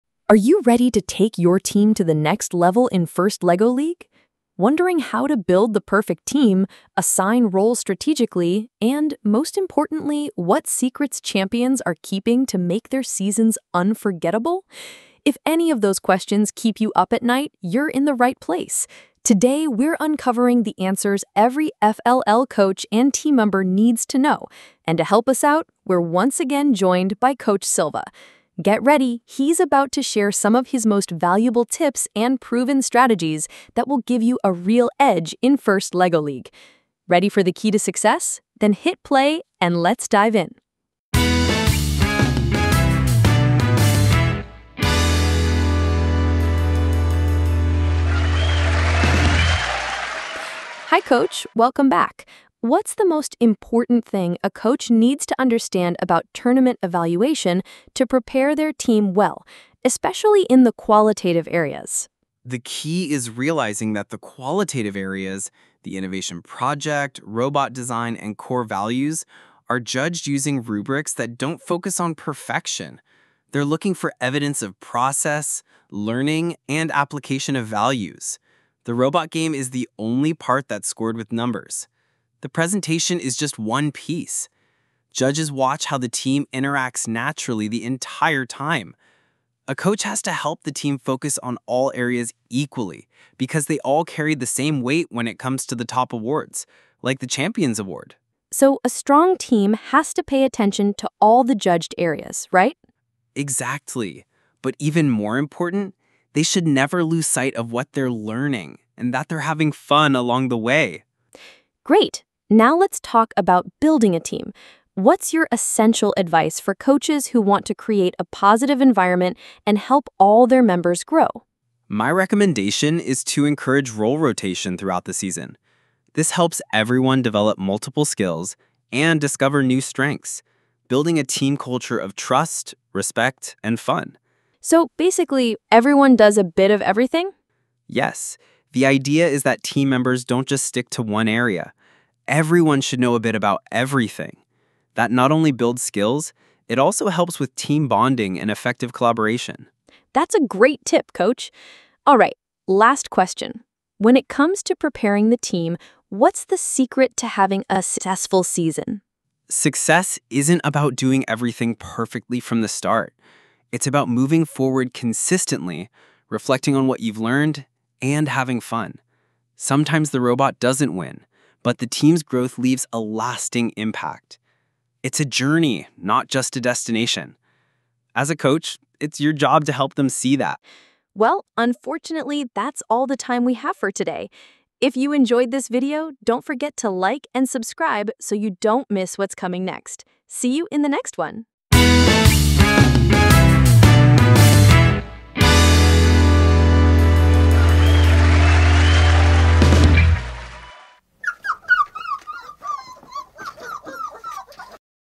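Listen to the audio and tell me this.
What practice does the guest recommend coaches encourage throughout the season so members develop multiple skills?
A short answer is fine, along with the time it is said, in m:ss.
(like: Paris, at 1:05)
Role rotation, at 2:03.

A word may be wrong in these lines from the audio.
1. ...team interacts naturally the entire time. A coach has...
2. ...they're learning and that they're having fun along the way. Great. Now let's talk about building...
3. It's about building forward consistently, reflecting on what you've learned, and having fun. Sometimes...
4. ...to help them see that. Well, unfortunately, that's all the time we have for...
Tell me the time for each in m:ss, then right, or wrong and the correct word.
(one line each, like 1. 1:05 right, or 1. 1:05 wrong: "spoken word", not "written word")
1. 1:26 right
2. 1:47 right
3. 2:43 wrong: "moving", not "building"
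4. 2:59 right.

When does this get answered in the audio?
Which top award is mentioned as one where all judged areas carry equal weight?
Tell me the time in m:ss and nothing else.
1:37.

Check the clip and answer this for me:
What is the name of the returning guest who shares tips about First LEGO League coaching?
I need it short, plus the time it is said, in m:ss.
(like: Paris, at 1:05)
Coach Silva, at 0:27.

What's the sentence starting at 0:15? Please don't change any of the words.
If any of those questions keep you up at night, you're in the right place.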